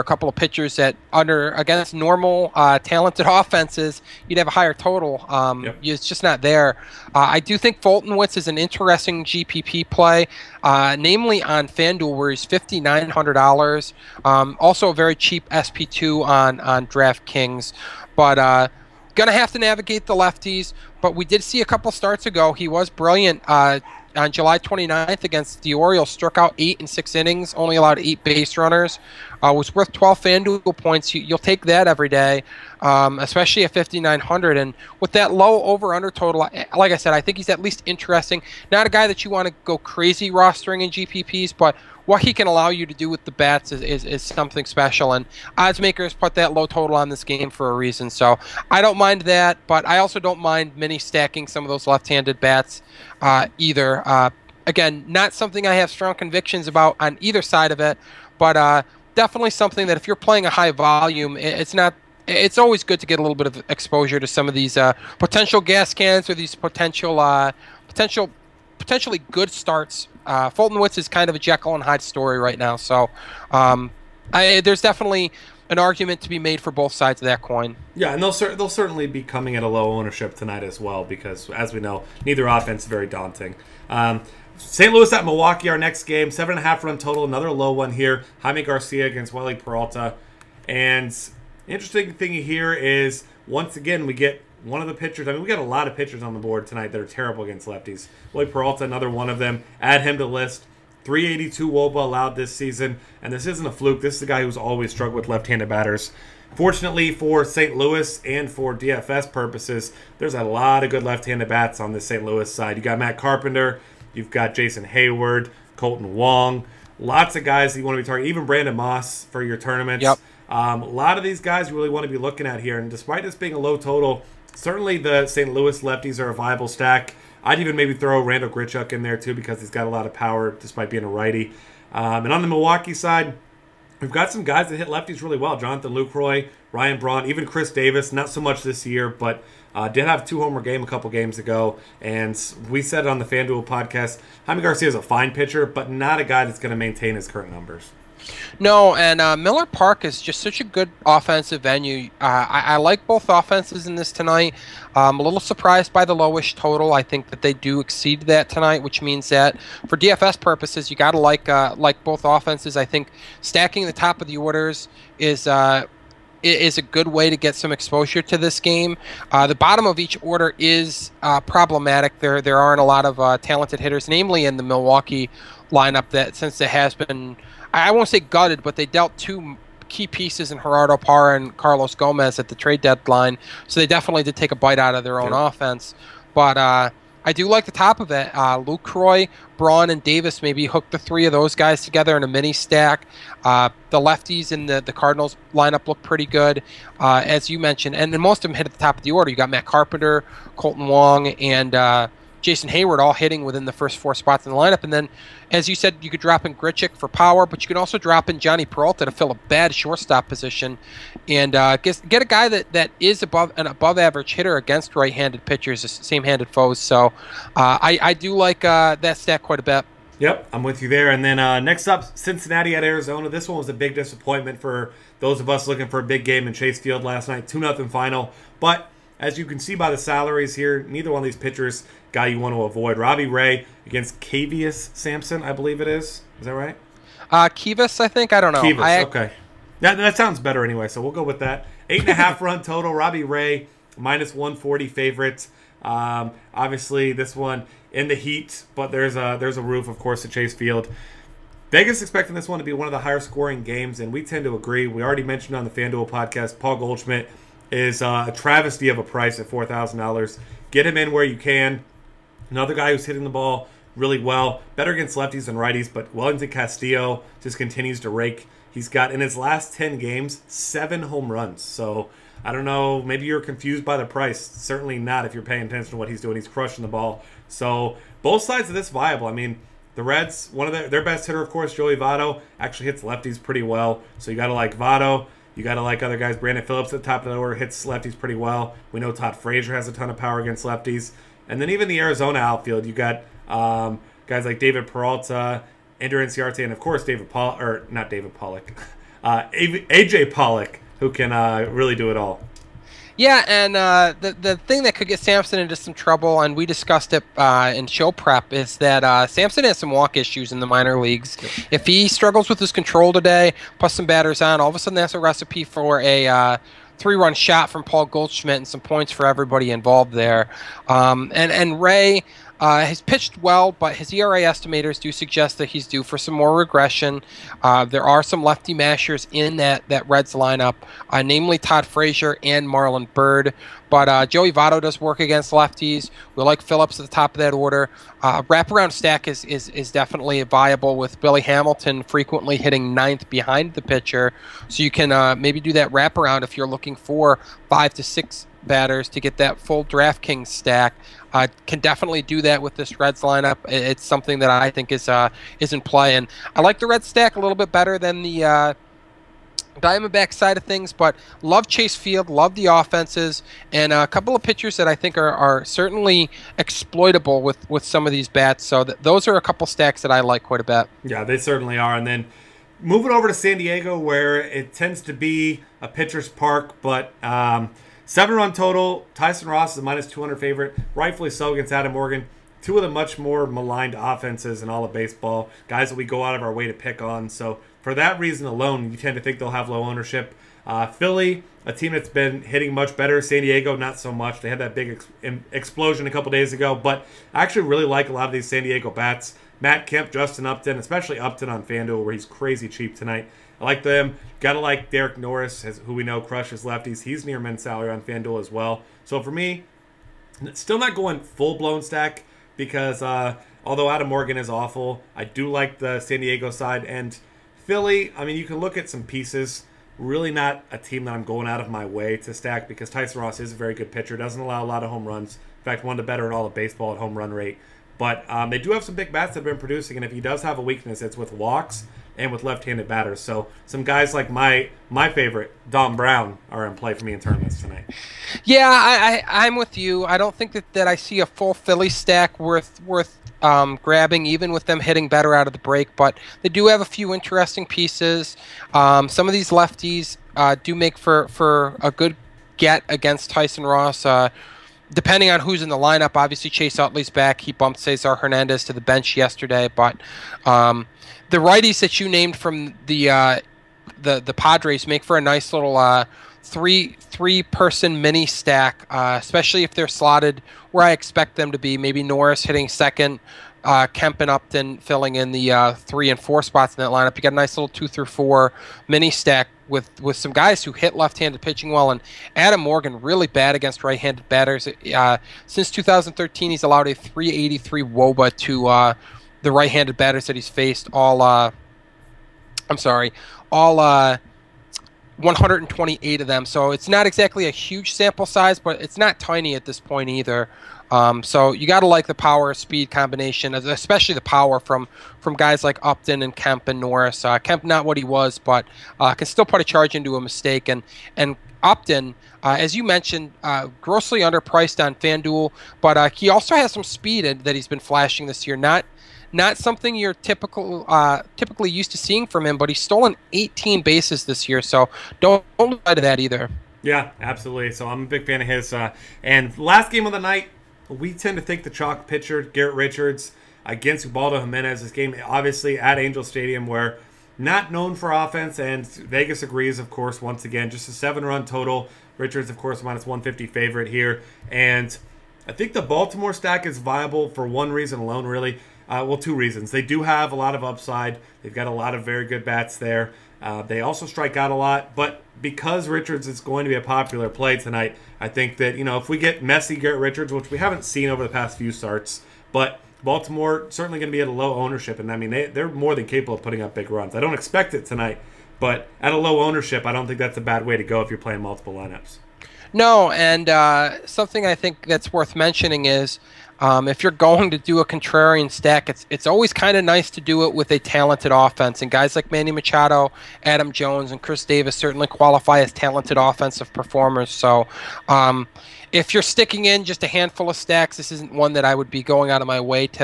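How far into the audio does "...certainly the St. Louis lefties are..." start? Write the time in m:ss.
2:04.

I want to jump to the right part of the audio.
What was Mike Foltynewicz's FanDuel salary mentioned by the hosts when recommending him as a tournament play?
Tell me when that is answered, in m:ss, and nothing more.
0:12.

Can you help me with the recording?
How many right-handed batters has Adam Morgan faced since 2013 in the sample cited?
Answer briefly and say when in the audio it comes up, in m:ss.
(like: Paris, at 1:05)
128, at 8:15.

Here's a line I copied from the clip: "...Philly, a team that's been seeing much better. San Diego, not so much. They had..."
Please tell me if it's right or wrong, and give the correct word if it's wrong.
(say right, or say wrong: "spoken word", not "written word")
wrong: "hitting", not "seeing".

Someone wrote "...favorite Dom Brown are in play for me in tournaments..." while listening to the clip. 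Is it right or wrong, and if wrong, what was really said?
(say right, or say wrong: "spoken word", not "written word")
right.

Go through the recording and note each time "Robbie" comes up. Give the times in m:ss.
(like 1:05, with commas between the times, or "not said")
3:52, 4:02.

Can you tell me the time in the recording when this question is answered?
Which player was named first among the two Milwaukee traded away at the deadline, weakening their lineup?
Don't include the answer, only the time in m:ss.
3:00.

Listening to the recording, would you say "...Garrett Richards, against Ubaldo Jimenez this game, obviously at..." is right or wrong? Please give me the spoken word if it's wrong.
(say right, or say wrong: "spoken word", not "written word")
right.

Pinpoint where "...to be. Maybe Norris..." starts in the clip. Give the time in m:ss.
7:51.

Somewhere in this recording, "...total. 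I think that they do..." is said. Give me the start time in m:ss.
2:36.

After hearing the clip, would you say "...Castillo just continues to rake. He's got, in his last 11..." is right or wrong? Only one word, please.
wrong.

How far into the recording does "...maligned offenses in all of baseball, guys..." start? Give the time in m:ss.
6:23.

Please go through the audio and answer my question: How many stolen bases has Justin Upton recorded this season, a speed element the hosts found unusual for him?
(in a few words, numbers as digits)
18.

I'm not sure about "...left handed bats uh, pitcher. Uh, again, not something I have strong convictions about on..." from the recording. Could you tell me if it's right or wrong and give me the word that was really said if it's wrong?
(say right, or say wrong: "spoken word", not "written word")
wrong: "either", not "pitcher".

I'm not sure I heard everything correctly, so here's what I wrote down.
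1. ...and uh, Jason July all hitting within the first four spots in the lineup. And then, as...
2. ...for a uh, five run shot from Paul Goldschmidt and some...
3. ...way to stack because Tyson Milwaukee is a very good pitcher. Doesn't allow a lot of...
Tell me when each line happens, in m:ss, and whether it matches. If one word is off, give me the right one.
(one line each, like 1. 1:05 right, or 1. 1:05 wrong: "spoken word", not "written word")
1. 3:21 wrong: "Heyward", not "July"
2. 5:15 wrong: "three", not "five"
3. 7:01 wrong: "Ross", not "Milwaukee".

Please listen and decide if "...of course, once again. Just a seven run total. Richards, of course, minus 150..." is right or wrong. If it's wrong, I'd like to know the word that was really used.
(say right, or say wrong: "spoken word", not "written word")
right.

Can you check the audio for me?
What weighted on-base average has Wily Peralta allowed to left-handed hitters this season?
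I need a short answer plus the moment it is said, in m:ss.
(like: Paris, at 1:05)
382, at 1:41.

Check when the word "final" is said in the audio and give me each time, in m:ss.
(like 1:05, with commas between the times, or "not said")
3:47.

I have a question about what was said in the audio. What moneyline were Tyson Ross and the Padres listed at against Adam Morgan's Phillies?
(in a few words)
-200.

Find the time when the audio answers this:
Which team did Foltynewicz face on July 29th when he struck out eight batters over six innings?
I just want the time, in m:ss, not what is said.
0:25.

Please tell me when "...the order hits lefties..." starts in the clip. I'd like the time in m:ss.
4:47.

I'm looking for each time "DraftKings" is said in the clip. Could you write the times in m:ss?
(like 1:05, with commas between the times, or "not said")
0:16, 5:49.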